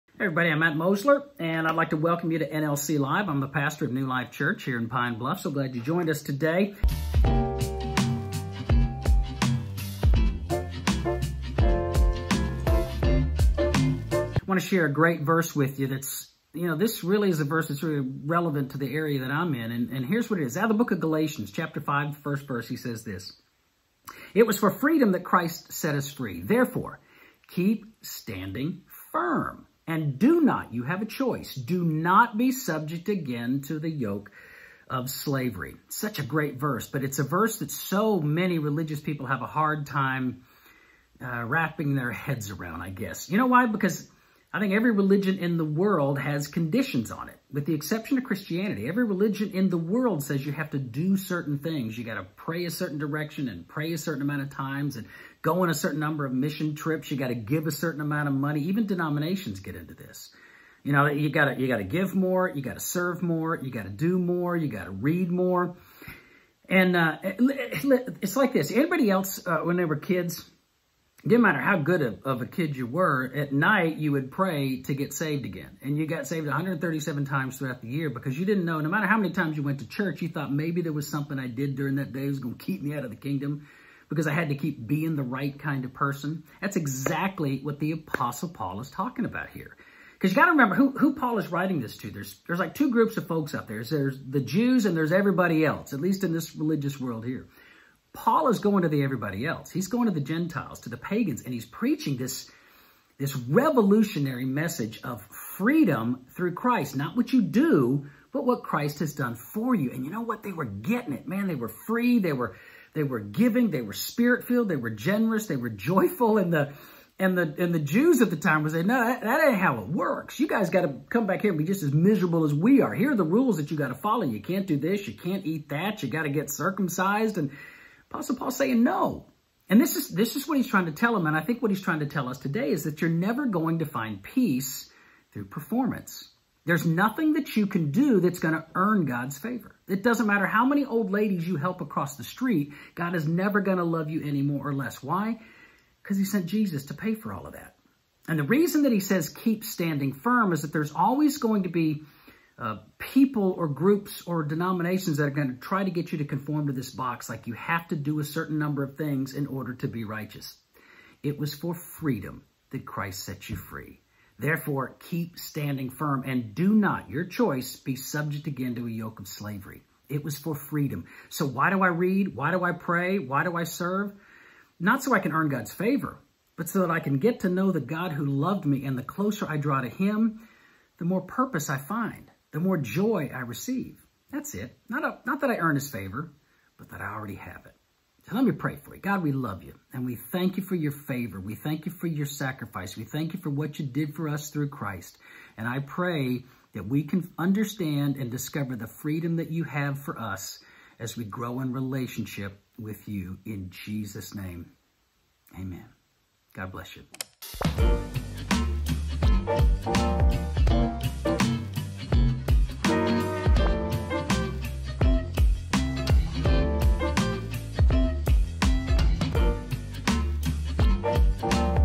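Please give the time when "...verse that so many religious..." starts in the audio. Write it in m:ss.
0:37.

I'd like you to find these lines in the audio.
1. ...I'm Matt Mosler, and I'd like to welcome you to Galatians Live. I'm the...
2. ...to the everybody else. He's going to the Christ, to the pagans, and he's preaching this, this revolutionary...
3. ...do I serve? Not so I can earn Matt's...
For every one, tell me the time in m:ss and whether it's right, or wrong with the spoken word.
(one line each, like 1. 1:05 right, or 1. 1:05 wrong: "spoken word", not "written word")
1. 0:00 wrong: "NLC", not "Galatians"
2. 1:38 wrong: "Gentiles", not "Christ"
3. 2:53 wrong: "God", not "Matt".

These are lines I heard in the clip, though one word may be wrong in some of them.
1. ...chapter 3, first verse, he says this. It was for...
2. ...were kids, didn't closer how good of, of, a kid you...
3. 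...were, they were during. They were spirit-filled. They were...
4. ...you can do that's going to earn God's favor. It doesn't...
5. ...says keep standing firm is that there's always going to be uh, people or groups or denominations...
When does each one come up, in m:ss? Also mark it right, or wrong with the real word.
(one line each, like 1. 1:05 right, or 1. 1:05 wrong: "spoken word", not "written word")
1. 0:21 wrong: "5", not "3"
2. 1:09 wrong: "matter", not "closer"
3. 1:52 wrong: "giving", not "during"
4. 2:17 right
5. 2:28 right.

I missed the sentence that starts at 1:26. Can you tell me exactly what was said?
That's exactly what the Apostle Paul is talking about here.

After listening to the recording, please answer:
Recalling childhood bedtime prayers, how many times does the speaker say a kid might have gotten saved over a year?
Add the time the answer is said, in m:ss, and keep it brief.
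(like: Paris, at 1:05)
137, at 1:16.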